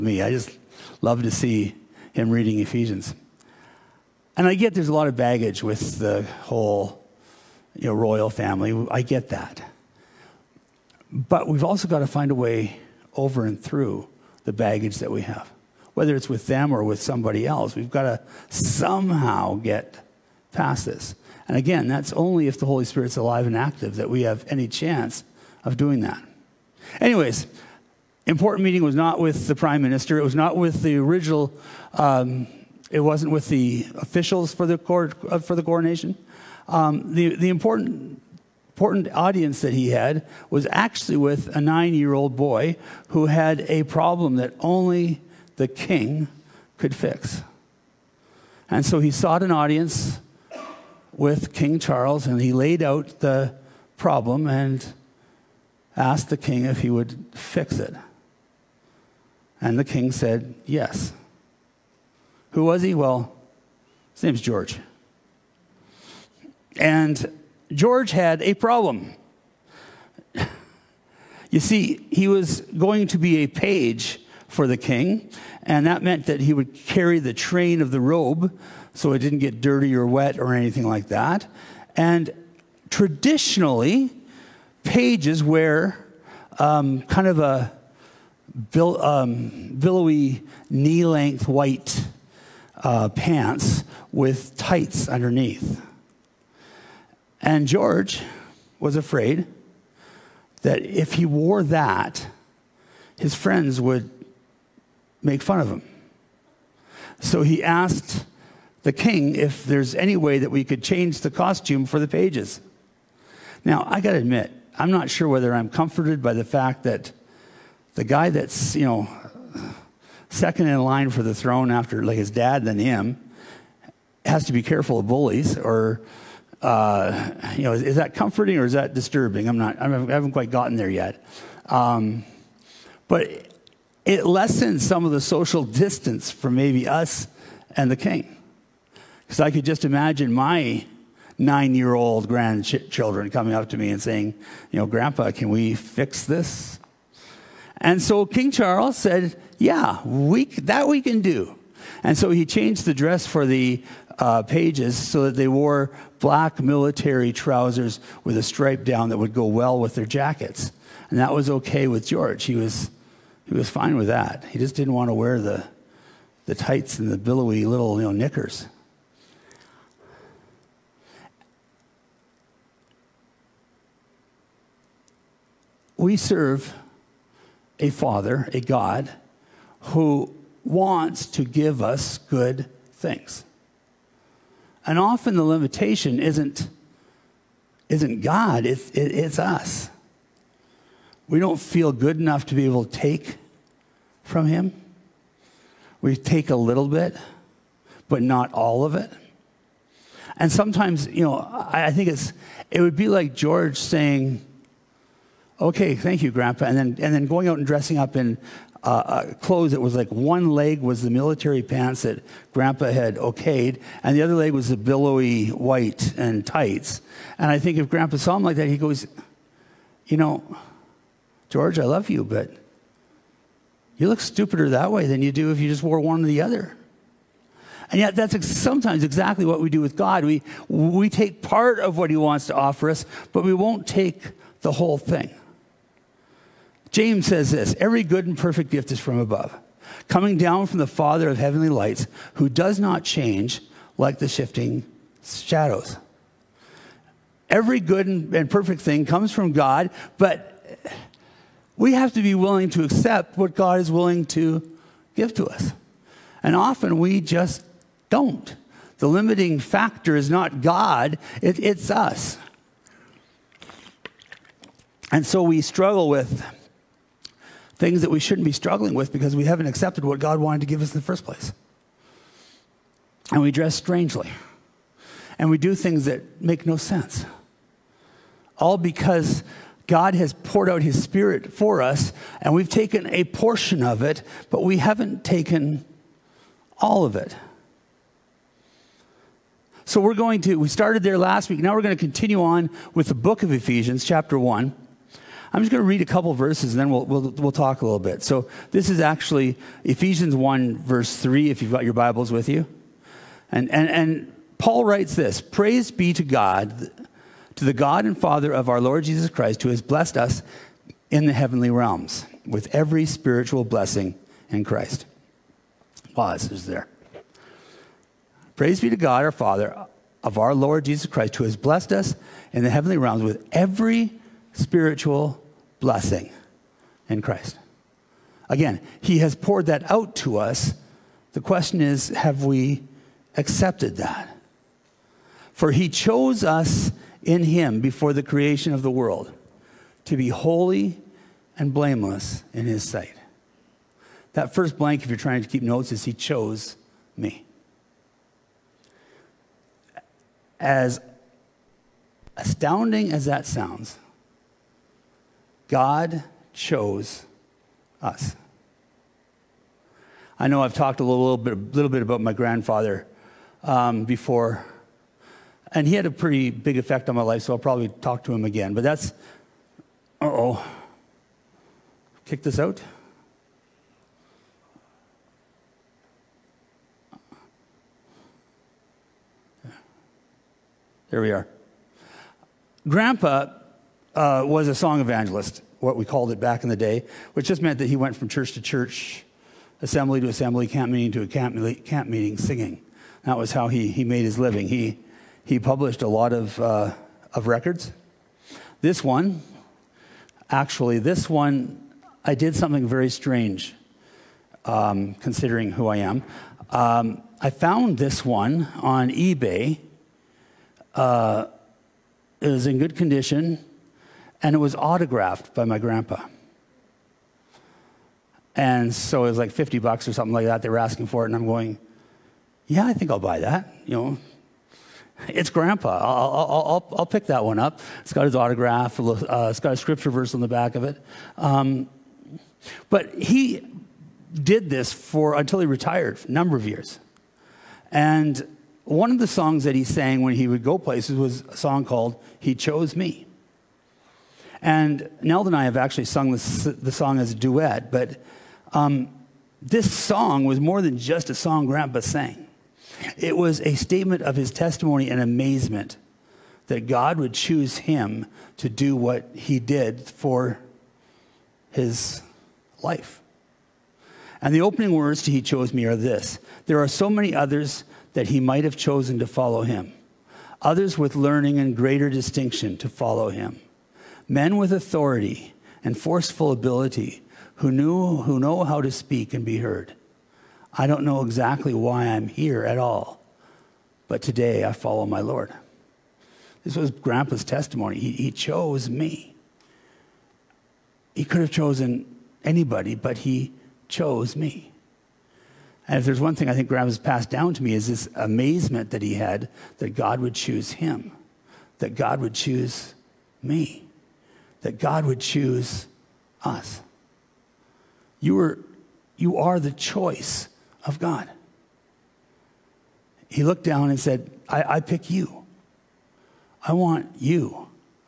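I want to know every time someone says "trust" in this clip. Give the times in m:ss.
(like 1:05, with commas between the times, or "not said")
not said.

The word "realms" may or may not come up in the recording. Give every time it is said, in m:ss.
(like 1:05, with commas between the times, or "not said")
5:11, 5:22.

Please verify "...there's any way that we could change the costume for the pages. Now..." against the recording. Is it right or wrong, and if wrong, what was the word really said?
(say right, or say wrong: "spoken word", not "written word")
right.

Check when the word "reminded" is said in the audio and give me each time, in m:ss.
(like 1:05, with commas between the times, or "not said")
not said.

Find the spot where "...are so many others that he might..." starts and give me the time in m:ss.
7:46.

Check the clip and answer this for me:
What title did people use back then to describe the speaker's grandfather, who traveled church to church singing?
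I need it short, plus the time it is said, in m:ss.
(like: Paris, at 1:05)
song evangelist, at 6:24.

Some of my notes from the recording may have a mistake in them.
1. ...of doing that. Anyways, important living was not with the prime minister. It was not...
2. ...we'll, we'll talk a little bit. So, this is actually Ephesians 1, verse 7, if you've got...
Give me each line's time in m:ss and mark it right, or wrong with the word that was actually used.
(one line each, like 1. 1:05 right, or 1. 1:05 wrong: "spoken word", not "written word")
1. 0:25 wrong: "meeting", not "living"
2. 4:57 wrong: "3", not "7".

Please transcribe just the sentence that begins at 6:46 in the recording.
Um, I found this one on eBay.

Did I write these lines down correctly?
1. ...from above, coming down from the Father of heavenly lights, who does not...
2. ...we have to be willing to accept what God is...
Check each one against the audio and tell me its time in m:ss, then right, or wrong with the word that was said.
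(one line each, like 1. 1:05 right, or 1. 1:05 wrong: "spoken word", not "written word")
1. 3:58 right
2. 4:11 right.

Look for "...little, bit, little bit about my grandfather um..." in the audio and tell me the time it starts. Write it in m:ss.
6:01.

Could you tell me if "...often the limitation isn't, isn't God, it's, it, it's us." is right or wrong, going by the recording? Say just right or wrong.
right.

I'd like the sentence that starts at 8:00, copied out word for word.
I don't know exactly why I'm here at all, but today I follow my Lord.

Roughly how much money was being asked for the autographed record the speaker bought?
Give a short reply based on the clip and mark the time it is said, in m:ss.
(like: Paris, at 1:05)
50 bucks, at 6:59.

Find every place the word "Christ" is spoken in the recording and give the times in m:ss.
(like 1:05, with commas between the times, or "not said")
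5:09, 5:14, 5:21, 5:27.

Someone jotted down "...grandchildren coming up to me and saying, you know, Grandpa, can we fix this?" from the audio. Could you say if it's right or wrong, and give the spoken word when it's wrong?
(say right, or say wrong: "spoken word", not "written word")
right.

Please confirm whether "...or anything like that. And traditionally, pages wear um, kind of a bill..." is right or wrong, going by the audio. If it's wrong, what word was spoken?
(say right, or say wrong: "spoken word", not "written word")
right.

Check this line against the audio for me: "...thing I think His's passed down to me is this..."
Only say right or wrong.
wrong.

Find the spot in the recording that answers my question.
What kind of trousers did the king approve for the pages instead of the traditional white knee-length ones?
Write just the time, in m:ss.
2:36.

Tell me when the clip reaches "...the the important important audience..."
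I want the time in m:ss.
0:37.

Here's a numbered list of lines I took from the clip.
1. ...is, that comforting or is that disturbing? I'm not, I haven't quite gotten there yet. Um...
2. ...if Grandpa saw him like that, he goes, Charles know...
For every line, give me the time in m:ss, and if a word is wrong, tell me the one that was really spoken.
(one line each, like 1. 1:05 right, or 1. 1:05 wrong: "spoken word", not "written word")
1. 2:07 right
2. 3:37 wrong: "You", not "Charles".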